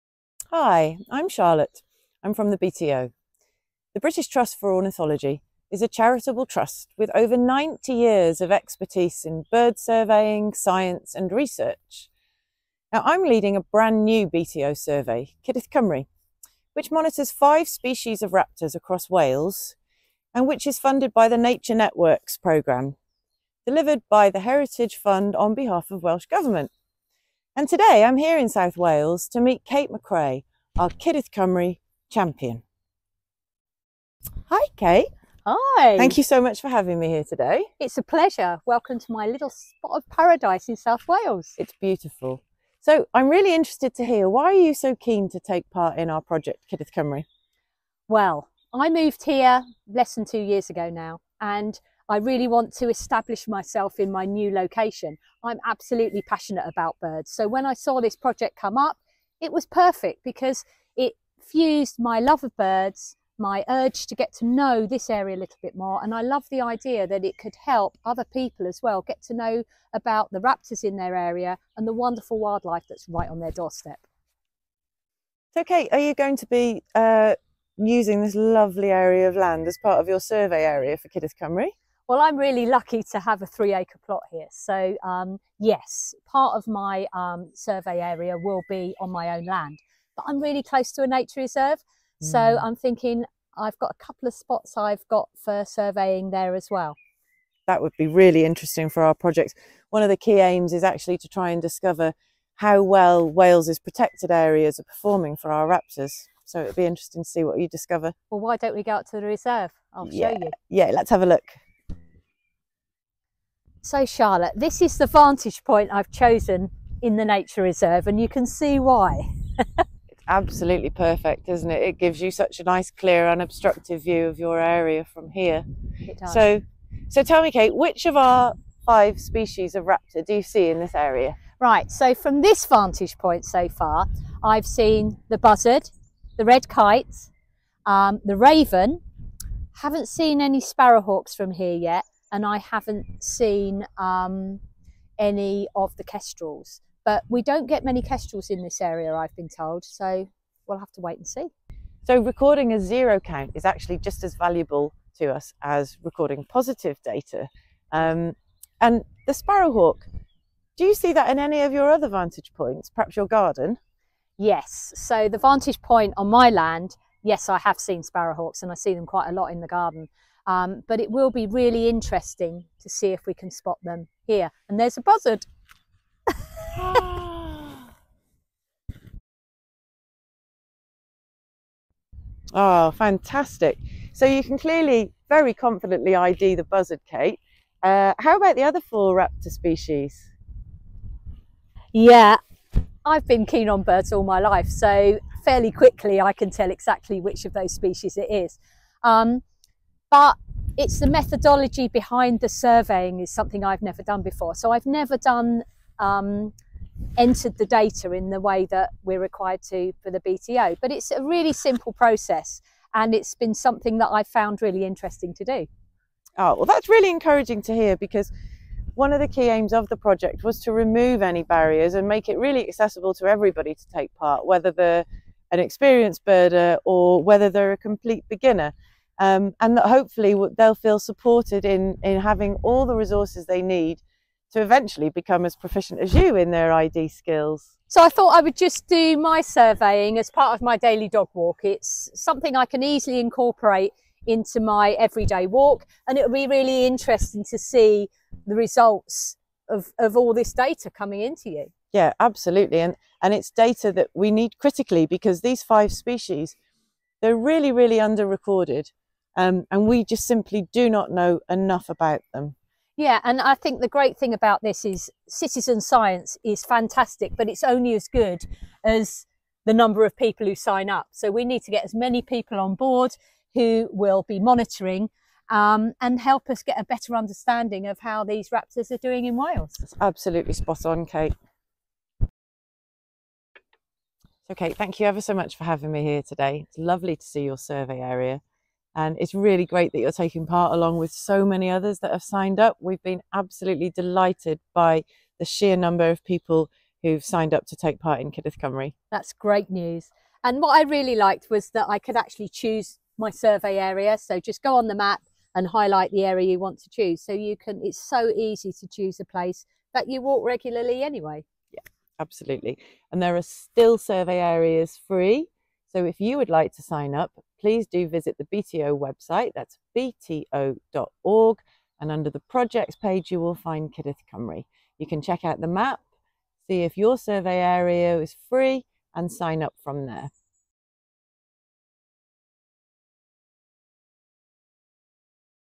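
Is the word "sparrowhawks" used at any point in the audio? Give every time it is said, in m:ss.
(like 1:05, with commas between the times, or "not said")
2:20, 2:39, 2:48.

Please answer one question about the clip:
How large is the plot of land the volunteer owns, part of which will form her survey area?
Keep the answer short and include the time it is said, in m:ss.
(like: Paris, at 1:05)
3 acres, at 1:23.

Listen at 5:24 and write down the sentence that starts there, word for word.
You can check out the map, see if your survey area is free, and sign up from there.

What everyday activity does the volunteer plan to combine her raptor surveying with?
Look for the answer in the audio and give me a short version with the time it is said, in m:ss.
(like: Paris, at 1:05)
daily dog walk, at 4:00.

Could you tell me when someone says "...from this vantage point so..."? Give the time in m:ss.
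2:12.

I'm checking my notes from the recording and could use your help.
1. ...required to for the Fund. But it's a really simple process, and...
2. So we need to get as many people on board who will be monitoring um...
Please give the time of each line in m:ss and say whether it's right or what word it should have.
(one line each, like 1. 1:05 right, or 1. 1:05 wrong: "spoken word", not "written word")
1. 3:29 wrong: "BTO", not "Fund"
2. 4:31 right.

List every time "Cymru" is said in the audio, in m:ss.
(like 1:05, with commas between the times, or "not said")
0:15, 0:31, 0:46, 1:21, 4:58, 5:24.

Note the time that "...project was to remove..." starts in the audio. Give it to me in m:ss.
3:39.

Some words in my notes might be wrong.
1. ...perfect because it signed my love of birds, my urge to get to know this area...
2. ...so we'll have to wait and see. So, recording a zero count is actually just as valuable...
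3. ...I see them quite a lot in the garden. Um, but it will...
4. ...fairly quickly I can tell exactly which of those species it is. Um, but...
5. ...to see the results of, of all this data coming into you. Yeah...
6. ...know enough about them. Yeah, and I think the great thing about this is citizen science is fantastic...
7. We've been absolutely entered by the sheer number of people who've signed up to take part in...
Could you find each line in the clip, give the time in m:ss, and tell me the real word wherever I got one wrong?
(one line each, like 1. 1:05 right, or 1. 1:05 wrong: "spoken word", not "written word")
1. 0:59 wrong: "fused", not "signed"
2. 2:29 right
3. 2:48 right
4. 3:15 right
5. 4:07 right
6. 4:21 right
7. 4:52 wrong: "delighted", not "entered".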